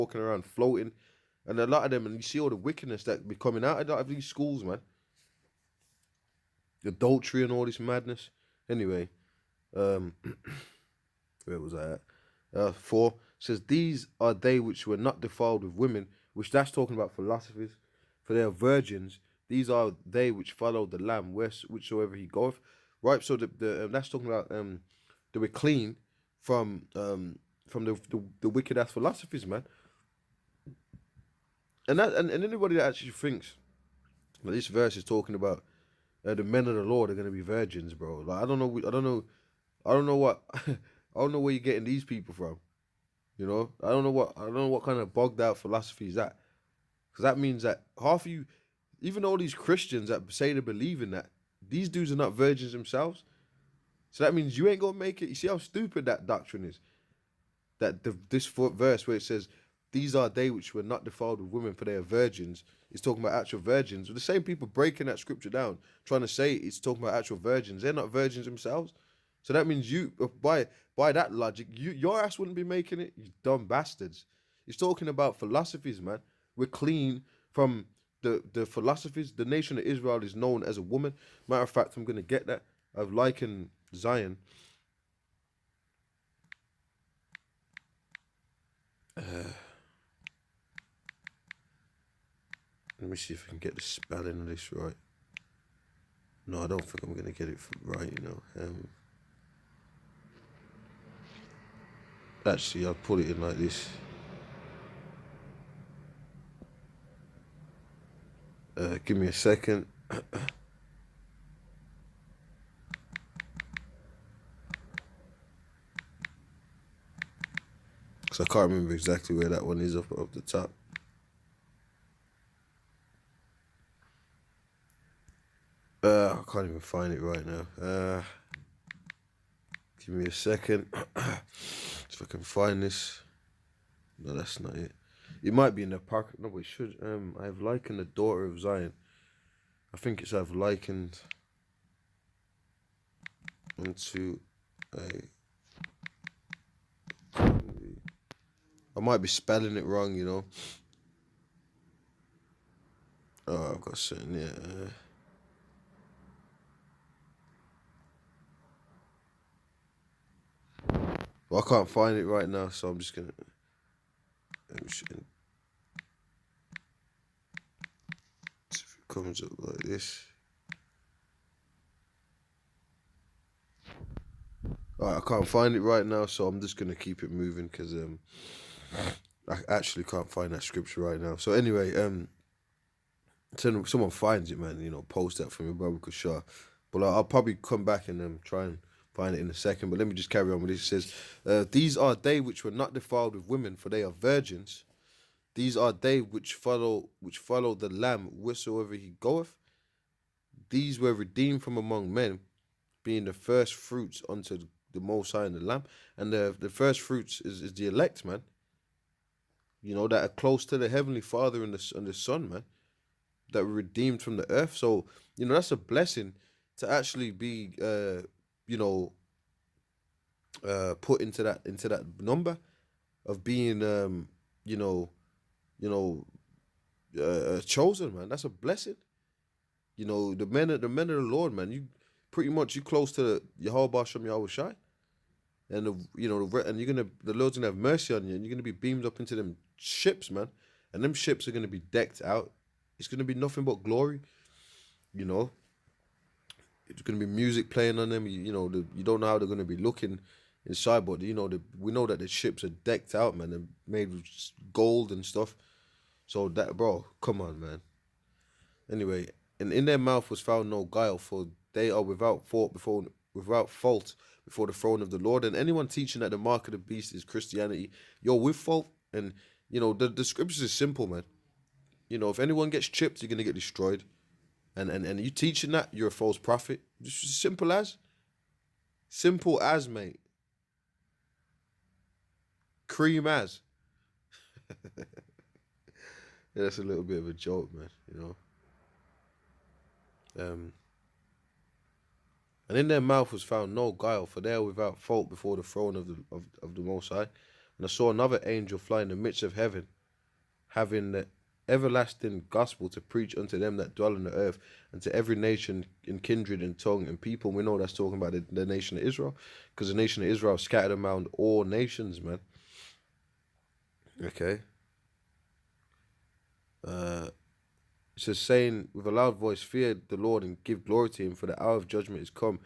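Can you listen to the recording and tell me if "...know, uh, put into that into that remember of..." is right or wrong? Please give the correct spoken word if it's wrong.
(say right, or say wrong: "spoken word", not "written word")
wrong: "number", not "remember".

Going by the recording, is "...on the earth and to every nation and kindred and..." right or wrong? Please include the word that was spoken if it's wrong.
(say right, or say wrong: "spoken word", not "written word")
right.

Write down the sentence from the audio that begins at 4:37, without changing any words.
Just simple as, simple as, mate.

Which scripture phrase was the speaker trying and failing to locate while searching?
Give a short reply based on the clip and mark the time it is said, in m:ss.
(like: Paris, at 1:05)
I've likened the daughter of Zion, at 2:17.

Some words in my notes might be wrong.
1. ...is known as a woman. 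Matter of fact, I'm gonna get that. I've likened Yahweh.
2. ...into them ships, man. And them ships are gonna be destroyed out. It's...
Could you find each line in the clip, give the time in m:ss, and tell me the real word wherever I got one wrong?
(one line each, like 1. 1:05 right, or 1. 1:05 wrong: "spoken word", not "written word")
1. 1:20 wrong: "Zion", not "Yahweh"
2. 3:59 wrong: "decked", not "destroyed".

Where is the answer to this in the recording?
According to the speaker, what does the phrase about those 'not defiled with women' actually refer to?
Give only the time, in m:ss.
0:17.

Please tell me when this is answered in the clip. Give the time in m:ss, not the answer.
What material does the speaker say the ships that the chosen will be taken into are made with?
4:14.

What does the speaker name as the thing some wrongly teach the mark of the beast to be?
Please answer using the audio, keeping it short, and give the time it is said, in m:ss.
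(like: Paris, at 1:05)
Christianity, at 4:27.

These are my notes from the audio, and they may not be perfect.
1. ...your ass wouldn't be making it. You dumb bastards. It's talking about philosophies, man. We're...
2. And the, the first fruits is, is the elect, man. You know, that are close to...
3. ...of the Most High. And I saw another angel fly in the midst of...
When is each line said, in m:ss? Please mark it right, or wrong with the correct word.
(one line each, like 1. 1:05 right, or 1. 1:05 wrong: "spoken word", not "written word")
1. 1:11 right
2. 3:26 right
3. 4:56 right.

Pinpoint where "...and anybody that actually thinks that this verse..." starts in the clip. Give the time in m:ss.
0:32.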